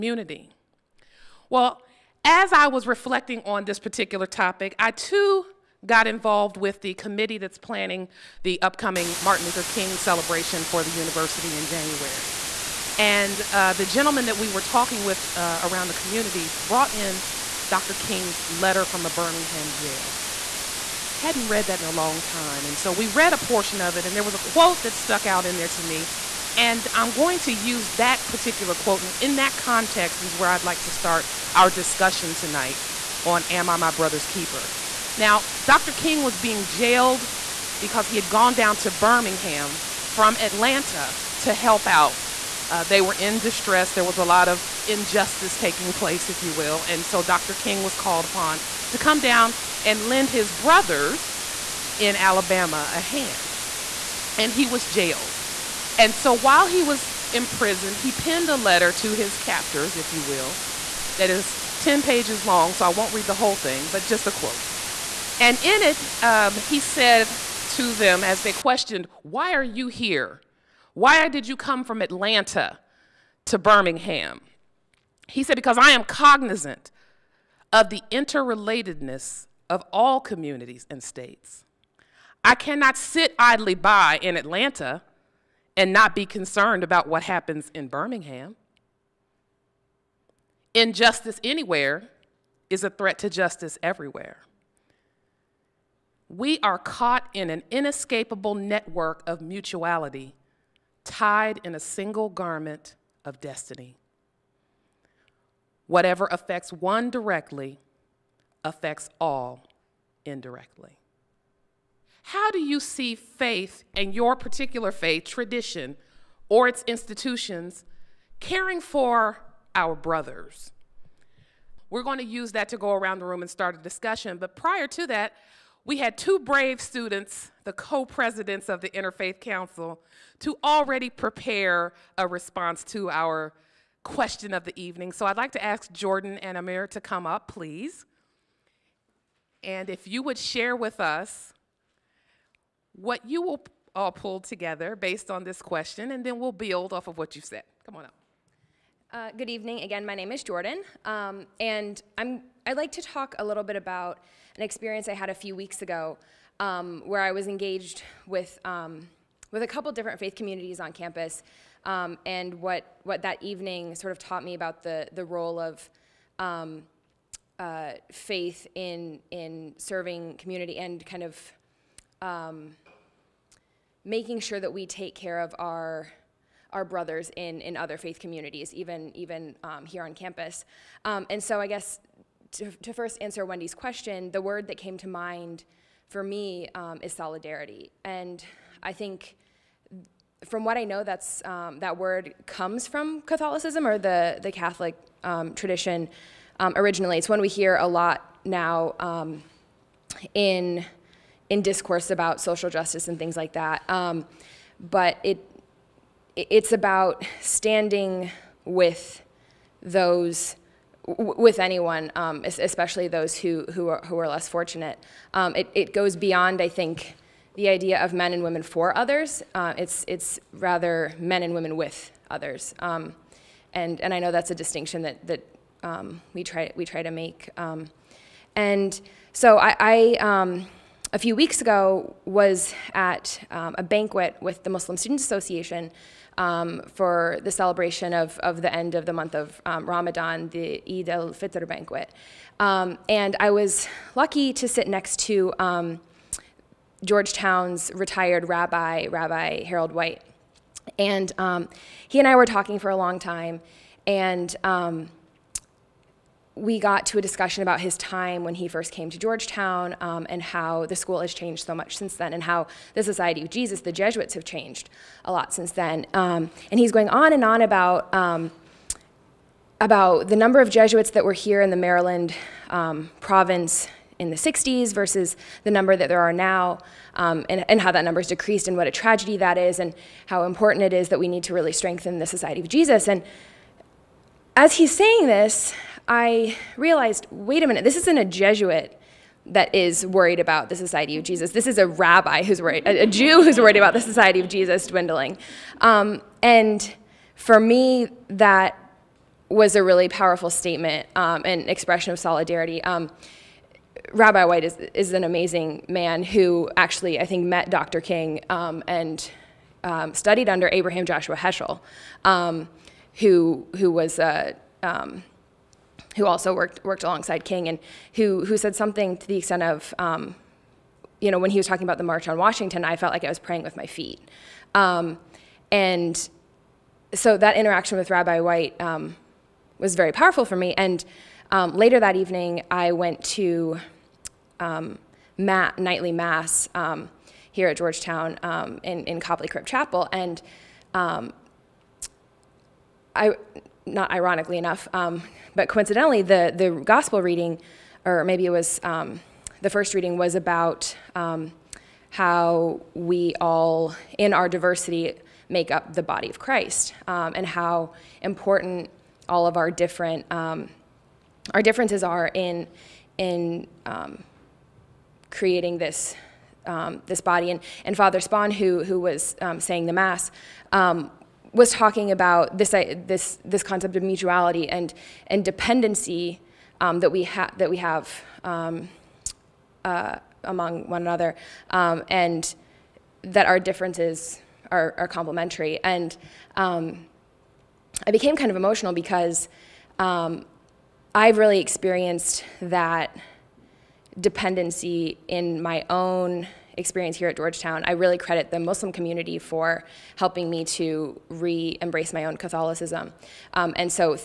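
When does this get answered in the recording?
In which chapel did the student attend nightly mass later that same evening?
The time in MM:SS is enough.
05:39.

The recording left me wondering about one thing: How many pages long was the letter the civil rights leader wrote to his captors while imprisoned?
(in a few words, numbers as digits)
10.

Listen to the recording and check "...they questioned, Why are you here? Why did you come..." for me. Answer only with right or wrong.
right.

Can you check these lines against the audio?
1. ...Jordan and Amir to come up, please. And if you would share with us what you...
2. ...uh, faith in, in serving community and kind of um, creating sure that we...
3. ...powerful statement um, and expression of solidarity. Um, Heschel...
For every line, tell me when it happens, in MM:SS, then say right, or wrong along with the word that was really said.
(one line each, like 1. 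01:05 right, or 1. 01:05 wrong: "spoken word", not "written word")
1. 02:15 right
2. 02:47 wrong: "making", not "creating"
3. 05:00 wrong: "Rabbi", not "Heschel".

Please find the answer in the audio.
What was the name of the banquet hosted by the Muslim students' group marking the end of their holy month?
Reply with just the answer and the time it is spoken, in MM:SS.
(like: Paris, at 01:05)
Eid al Fitr banquet, at 04:00.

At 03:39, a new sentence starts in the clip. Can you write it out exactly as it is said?
Uh, it's, it's rather men and women with others.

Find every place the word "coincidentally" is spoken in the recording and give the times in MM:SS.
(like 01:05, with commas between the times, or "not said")
05:45.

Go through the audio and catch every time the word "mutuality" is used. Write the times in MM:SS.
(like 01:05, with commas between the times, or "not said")
01:39, 06:14.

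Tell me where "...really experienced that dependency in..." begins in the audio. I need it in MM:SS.
06:31.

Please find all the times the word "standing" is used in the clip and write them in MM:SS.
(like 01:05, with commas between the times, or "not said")
03:27.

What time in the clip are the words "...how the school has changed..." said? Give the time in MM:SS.
04:20.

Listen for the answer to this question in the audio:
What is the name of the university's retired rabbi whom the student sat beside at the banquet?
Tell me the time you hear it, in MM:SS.
04:09.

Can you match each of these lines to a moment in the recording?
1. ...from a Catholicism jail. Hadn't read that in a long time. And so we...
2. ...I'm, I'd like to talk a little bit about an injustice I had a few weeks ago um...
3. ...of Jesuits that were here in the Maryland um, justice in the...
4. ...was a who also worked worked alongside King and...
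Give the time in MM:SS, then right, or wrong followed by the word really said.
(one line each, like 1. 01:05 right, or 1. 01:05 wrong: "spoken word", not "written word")
1. 00:18 wrong: "Birmingham", not "Catholicism"
2. 02:32 wrong: "experience", not "injustice"
3. 04:30 wrong: "province", not "justice"
4. 05:13 right.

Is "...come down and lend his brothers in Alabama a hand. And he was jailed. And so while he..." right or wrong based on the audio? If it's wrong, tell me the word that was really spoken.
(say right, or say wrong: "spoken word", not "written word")
right.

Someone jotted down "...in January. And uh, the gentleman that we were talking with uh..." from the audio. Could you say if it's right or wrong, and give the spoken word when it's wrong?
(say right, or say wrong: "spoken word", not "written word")
right.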